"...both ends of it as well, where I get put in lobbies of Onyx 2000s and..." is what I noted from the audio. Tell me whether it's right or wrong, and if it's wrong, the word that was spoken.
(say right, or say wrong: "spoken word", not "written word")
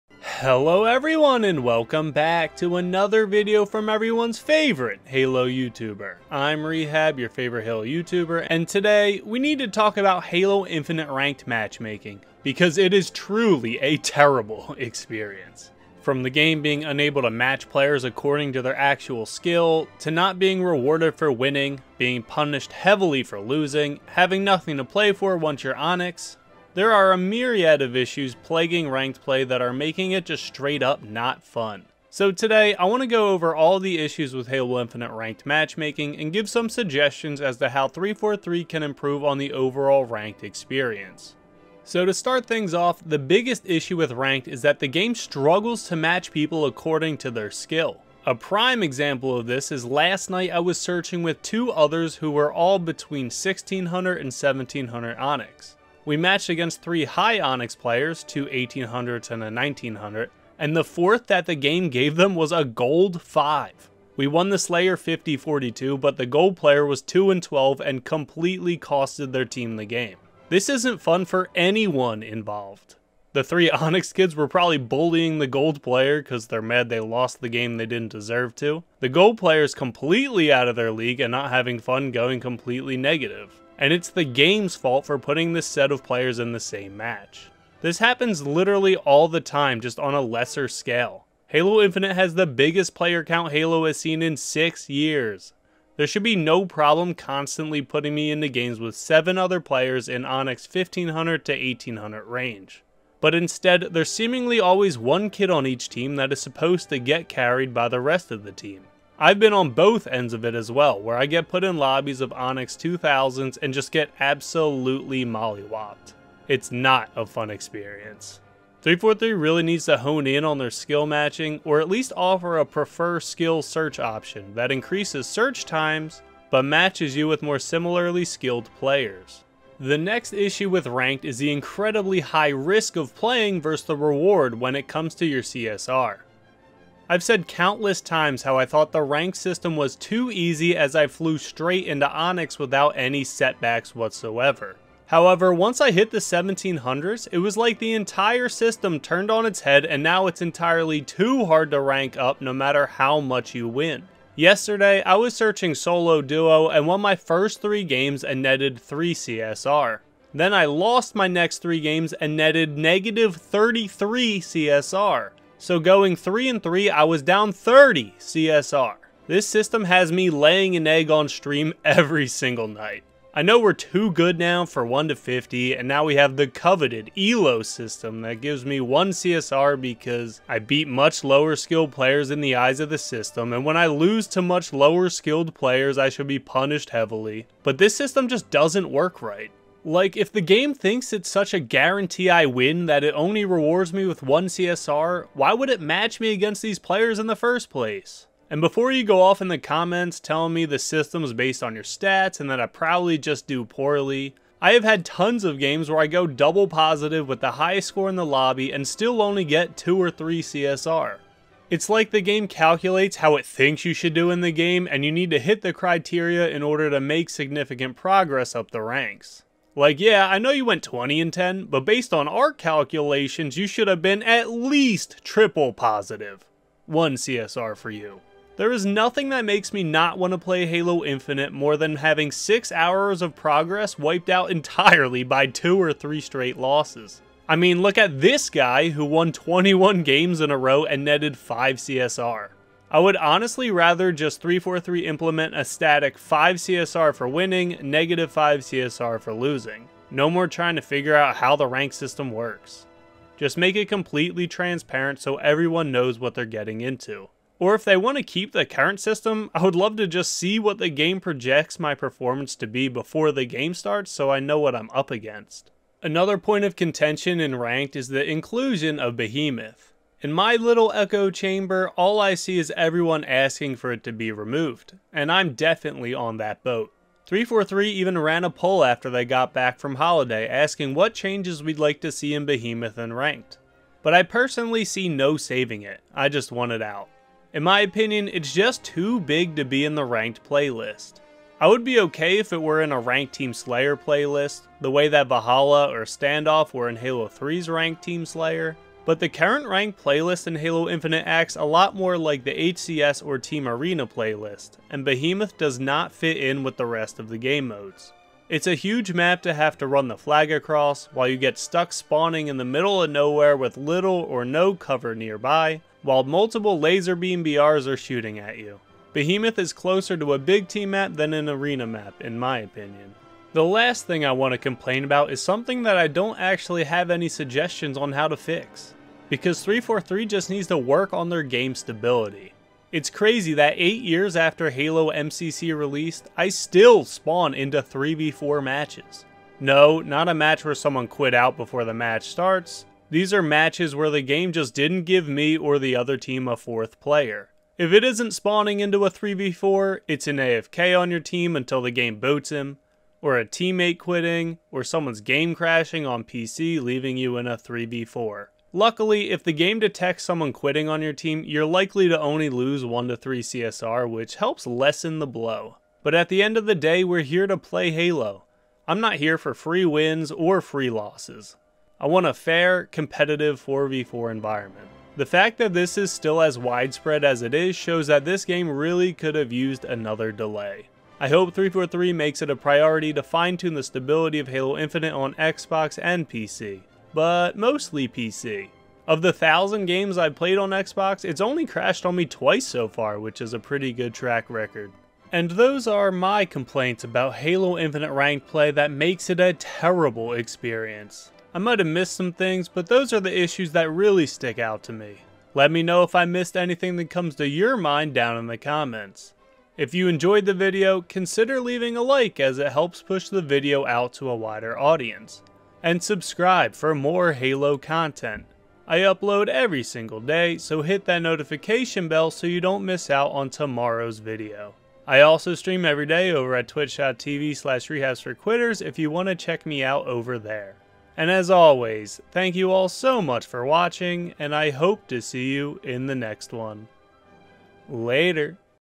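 right.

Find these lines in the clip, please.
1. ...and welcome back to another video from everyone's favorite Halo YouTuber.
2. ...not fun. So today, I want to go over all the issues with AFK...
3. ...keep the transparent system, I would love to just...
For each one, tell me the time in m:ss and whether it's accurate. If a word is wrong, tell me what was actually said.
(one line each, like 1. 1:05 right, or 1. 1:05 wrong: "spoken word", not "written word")
1. 0:01 right
2. 0:31 wrong: "Halo", not "AFK"
3. 4:18 wrong: "current", not "transparent".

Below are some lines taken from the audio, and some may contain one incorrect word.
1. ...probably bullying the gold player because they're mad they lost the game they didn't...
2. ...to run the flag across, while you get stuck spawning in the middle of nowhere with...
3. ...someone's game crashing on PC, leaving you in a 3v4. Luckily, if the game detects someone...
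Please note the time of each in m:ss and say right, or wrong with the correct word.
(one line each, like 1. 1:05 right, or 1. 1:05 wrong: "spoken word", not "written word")
1. 1:14 right
2. 5:09 right
3. 5:54 right.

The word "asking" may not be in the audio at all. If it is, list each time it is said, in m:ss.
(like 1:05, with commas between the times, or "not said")
4:33, 4:40.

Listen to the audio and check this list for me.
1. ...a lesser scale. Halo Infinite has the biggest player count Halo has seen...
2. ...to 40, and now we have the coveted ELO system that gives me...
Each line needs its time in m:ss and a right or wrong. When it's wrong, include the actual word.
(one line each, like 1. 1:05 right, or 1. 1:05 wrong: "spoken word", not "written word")
1. 1:30 right
2. 2:55 wrong: "50", not "40".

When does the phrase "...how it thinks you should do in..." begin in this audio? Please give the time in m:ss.
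3:33.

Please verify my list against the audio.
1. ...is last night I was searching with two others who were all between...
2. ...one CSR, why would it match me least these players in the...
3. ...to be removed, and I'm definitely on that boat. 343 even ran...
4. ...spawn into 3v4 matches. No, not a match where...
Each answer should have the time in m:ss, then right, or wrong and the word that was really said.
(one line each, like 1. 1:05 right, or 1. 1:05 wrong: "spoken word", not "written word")
1. 0:49 right
2. 3:14 wrong: "against", not "least"
3. 4:34 right
4. 5:37 right.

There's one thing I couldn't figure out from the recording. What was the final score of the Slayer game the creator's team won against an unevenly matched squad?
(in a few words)
50-42.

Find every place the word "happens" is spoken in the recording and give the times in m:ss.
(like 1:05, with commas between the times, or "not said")
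1:27.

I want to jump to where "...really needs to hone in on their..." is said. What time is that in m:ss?
1:59.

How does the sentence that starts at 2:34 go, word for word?
Yesterday, I was searching solo duo and won my first 3 games and netted 3 CSR.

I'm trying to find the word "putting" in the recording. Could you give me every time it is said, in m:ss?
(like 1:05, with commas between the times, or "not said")
1:25, 1:37.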